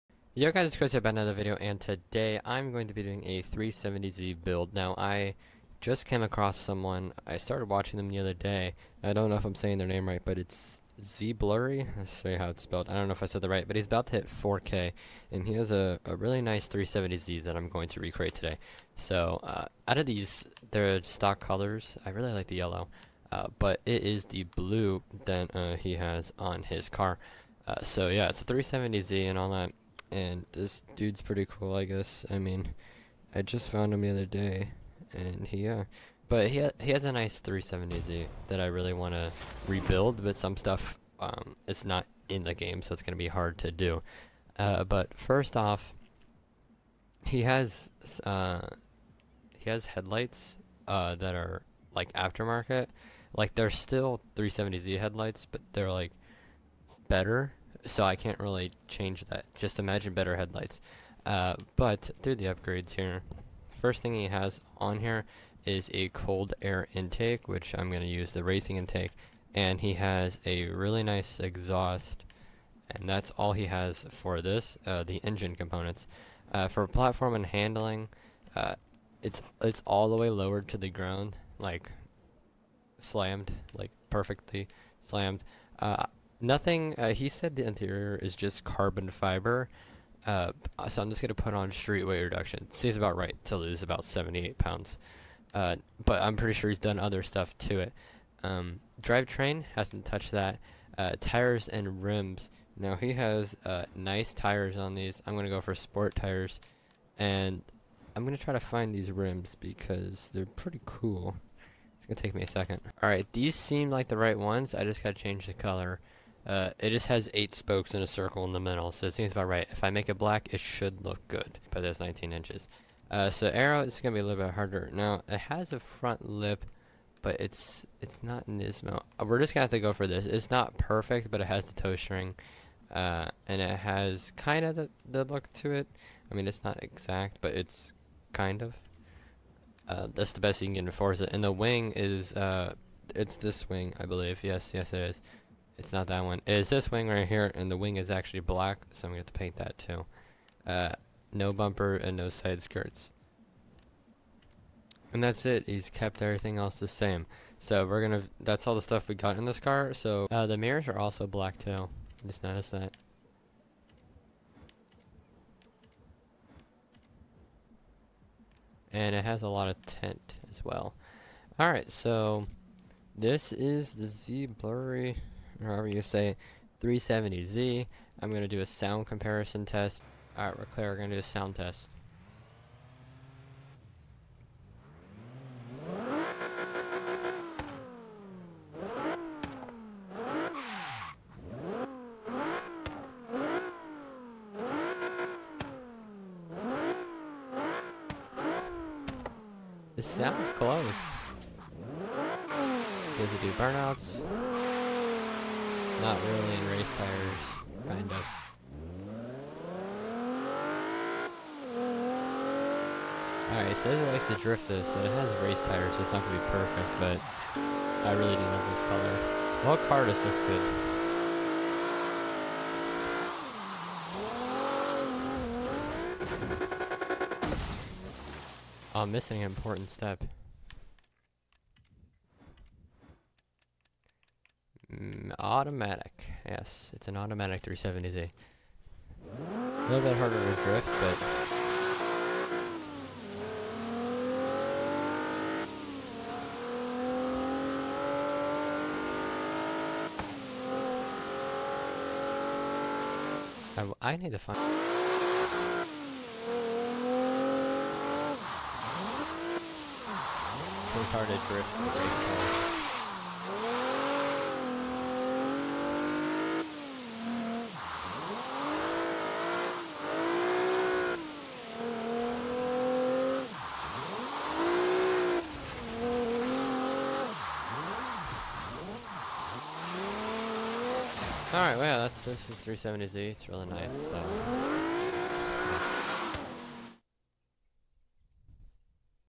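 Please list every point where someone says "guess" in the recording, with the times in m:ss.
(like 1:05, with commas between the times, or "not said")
0:31.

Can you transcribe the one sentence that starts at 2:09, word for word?
Uh, we're just going to have to go for this.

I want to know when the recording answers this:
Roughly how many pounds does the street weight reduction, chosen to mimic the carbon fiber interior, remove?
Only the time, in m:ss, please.
1:34.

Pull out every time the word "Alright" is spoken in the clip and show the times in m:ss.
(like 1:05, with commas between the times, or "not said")
2:51, 3:00, 3:33, 4:41.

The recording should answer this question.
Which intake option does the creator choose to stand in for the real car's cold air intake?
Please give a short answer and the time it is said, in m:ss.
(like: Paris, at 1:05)
Racing intake, at 1:08.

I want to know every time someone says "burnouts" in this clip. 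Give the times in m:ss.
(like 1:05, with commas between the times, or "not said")
3:23.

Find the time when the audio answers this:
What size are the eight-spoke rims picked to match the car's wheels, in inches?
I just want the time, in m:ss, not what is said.
2:01.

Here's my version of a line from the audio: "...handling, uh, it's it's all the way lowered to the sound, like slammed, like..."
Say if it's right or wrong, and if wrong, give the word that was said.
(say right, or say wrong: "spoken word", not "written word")
wrong: "ground", not "sound".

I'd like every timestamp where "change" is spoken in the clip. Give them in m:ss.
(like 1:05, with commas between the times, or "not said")
0:58, 1:55.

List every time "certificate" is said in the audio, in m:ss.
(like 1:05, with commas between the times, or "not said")
not said.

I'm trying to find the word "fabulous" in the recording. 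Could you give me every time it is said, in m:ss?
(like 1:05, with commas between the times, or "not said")
not said.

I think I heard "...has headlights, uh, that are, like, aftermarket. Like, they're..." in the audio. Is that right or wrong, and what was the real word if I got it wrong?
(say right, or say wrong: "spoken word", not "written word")
right.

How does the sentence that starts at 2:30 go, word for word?
Uh, no bumper and no side skirts.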